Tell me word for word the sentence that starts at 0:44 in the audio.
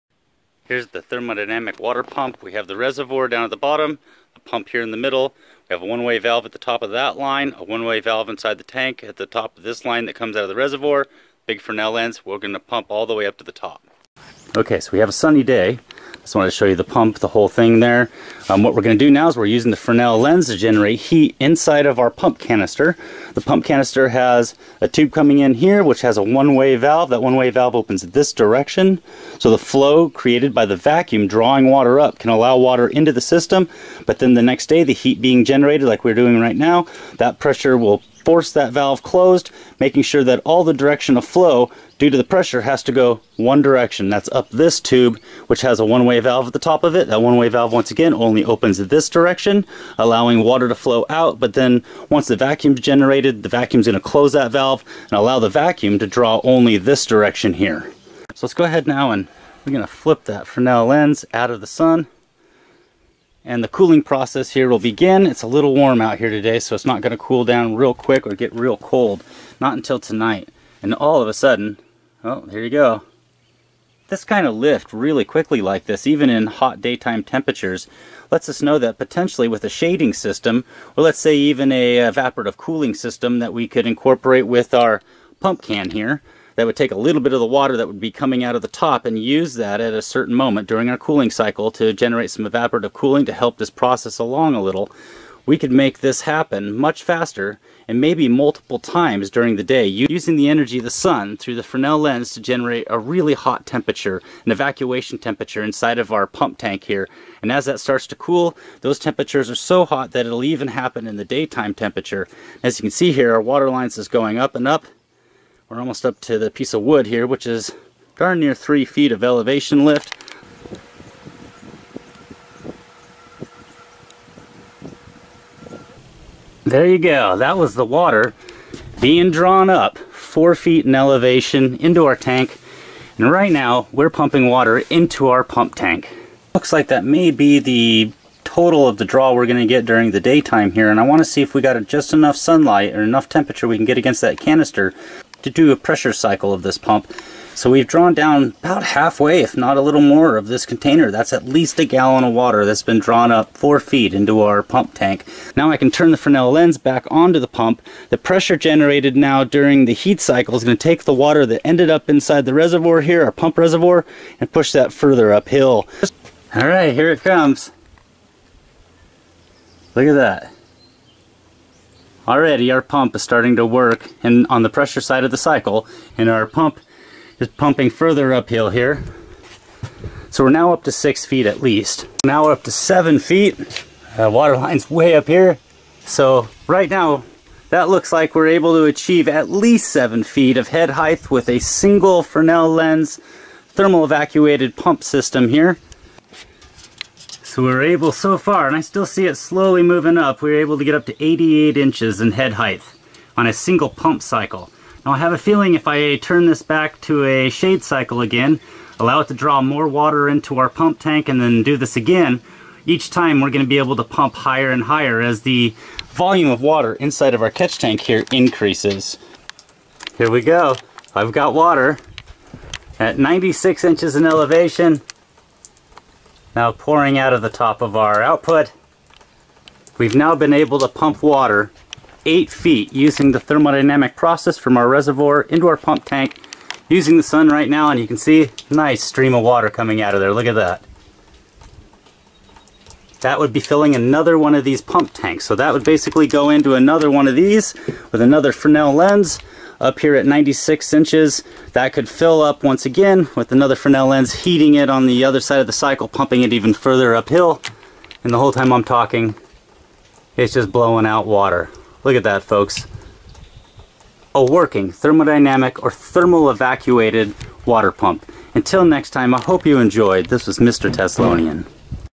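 That's up this tube, which has a one-way valve at the top of it.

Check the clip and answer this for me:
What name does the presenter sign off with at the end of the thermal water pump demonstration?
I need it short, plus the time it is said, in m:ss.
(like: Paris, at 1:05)
Mr. Teslonian, at 4:30.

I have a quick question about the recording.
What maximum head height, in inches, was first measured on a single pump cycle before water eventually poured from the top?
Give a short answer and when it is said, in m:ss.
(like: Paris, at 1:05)
88 inches, at 3:21.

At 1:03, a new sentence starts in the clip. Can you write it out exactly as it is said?
And the cooling process here will begin.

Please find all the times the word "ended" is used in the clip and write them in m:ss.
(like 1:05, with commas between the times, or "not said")
2:41.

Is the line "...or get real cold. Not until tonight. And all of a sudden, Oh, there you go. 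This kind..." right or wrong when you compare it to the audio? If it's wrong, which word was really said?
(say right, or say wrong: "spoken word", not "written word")
right.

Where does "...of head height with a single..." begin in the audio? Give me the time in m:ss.
3:10.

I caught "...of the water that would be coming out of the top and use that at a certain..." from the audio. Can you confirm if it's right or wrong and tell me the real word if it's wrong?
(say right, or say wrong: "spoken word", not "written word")
right.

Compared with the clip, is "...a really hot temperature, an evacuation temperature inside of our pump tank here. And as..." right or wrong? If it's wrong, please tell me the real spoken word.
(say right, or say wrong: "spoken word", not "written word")
right.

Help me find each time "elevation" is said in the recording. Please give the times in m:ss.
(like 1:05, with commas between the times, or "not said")
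1:59, 2:10, 3:44.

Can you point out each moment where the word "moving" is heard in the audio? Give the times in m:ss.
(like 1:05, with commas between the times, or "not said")
3:19.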